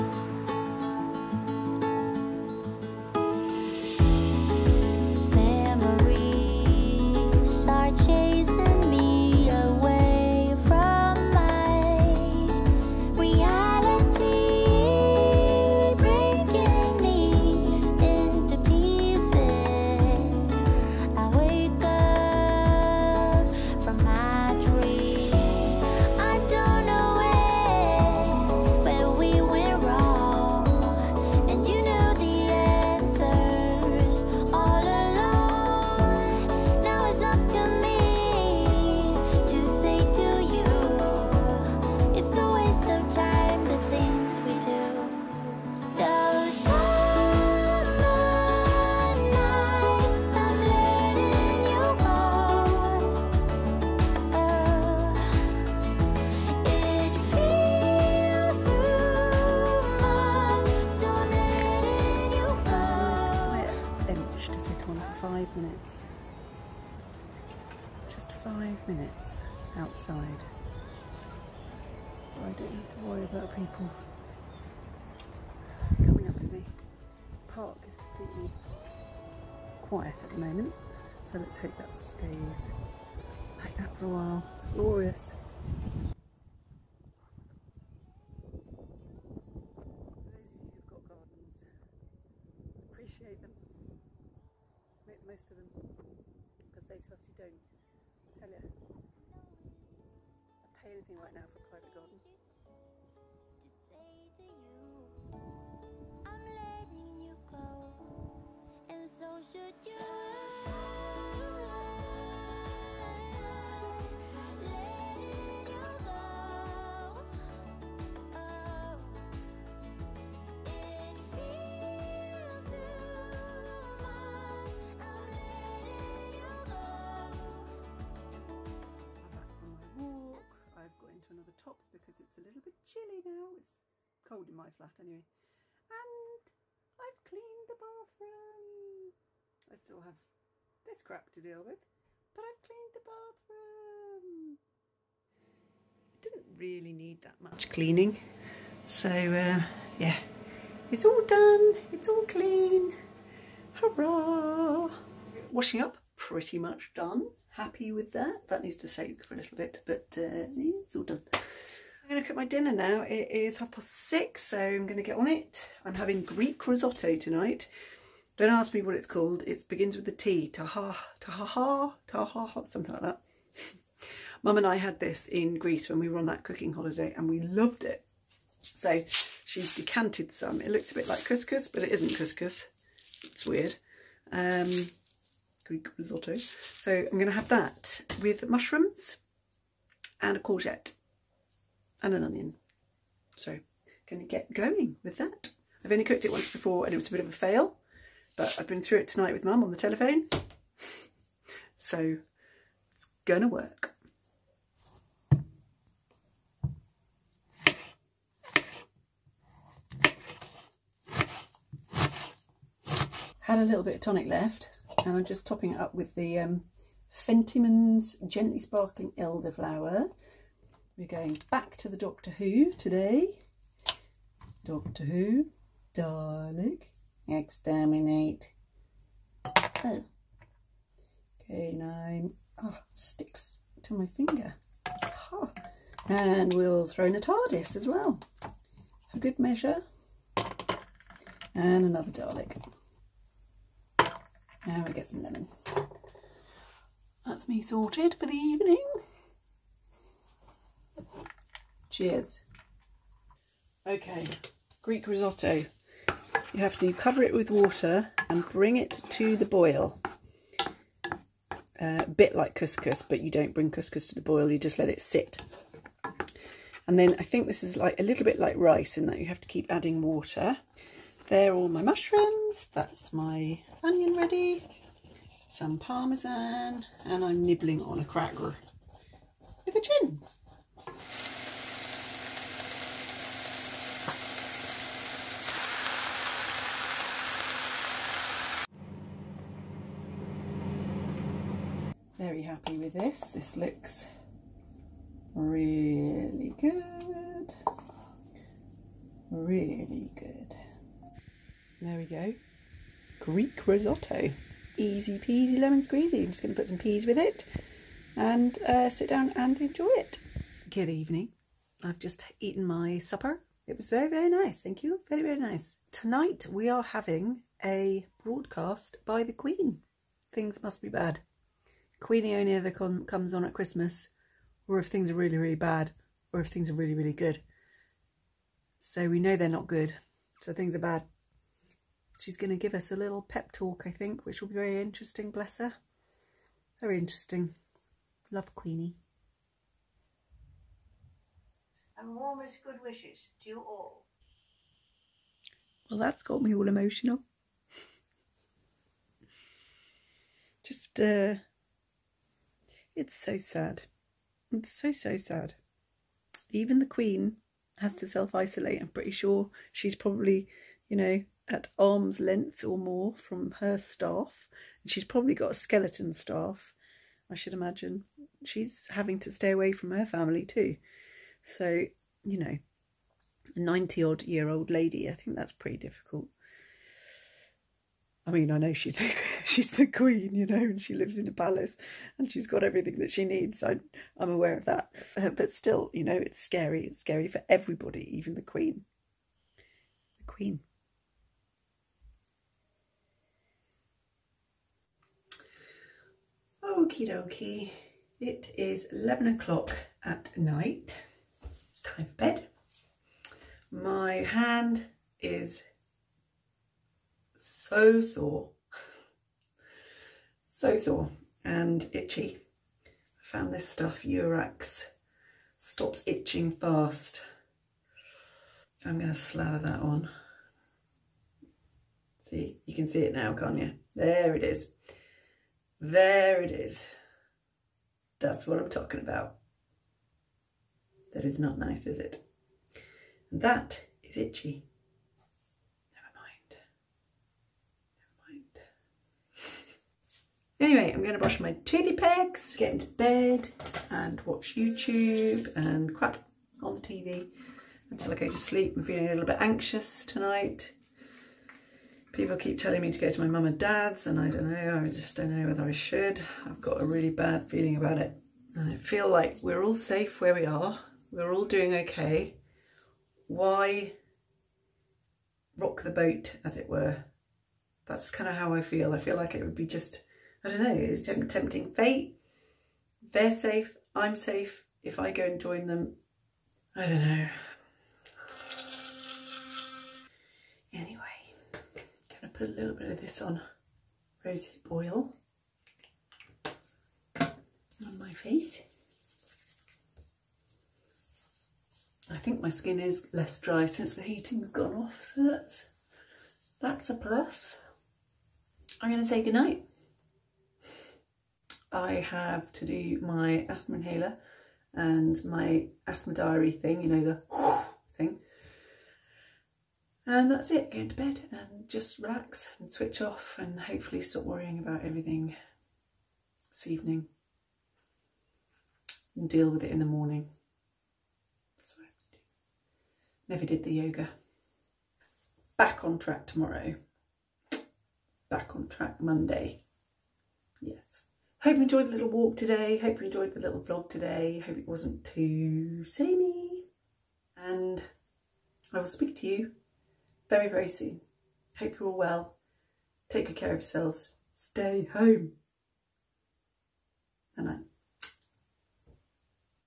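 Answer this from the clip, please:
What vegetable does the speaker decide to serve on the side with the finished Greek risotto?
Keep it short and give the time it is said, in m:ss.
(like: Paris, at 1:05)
Peas, at 5:06.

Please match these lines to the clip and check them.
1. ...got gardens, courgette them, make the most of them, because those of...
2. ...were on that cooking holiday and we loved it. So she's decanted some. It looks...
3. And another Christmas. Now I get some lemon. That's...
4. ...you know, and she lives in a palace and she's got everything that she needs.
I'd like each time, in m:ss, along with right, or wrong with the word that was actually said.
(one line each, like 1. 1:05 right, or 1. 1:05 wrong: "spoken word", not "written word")
1. 1:30 wrong: "appreciate", not "courgette"
2. 2:56 right
3. 4:01 wrong: "Dalek", not "Christmas"
4. 6:20 right.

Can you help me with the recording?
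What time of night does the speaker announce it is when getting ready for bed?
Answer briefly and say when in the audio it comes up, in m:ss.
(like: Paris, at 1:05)
11 o'clock, at 6:38.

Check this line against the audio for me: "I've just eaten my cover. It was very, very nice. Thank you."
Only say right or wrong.
wrong.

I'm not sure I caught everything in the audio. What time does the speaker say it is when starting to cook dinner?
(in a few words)
Half past six.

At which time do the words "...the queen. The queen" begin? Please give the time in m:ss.
6:28.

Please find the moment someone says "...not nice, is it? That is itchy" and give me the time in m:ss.
7:11.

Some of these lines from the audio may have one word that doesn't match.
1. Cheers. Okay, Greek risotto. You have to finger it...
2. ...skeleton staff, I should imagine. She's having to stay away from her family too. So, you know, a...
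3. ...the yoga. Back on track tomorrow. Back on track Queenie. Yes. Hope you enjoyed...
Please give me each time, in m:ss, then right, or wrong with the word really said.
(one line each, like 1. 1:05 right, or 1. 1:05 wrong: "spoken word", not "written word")
1. 4:11 wrong: "cover", not "finger"
2. 6:05 right
3. 8:43 wrong: "Monday", not "Queenie".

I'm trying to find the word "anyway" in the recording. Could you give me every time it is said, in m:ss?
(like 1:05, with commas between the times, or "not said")
2:14, 7:20.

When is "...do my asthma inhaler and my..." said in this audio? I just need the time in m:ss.
8:22.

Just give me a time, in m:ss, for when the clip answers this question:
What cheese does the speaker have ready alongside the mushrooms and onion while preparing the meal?
4:35.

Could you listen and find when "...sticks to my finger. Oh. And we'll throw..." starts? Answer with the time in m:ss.
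3:52.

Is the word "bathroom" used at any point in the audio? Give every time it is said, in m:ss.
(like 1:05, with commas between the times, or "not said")
2:17, 2:23.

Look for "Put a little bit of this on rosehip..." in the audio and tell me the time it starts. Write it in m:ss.
8:02.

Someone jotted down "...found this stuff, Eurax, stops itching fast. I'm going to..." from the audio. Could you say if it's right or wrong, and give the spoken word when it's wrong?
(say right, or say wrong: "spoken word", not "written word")
right.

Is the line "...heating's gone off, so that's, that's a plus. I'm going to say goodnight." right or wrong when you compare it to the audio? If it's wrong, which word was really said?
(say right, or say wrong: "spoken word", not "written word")
right.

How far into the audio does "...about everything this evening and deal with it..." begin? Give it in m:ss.
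8:34.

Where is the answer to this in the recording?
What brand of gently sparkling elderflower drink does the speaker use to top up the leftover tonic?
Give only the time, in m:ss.
3:37.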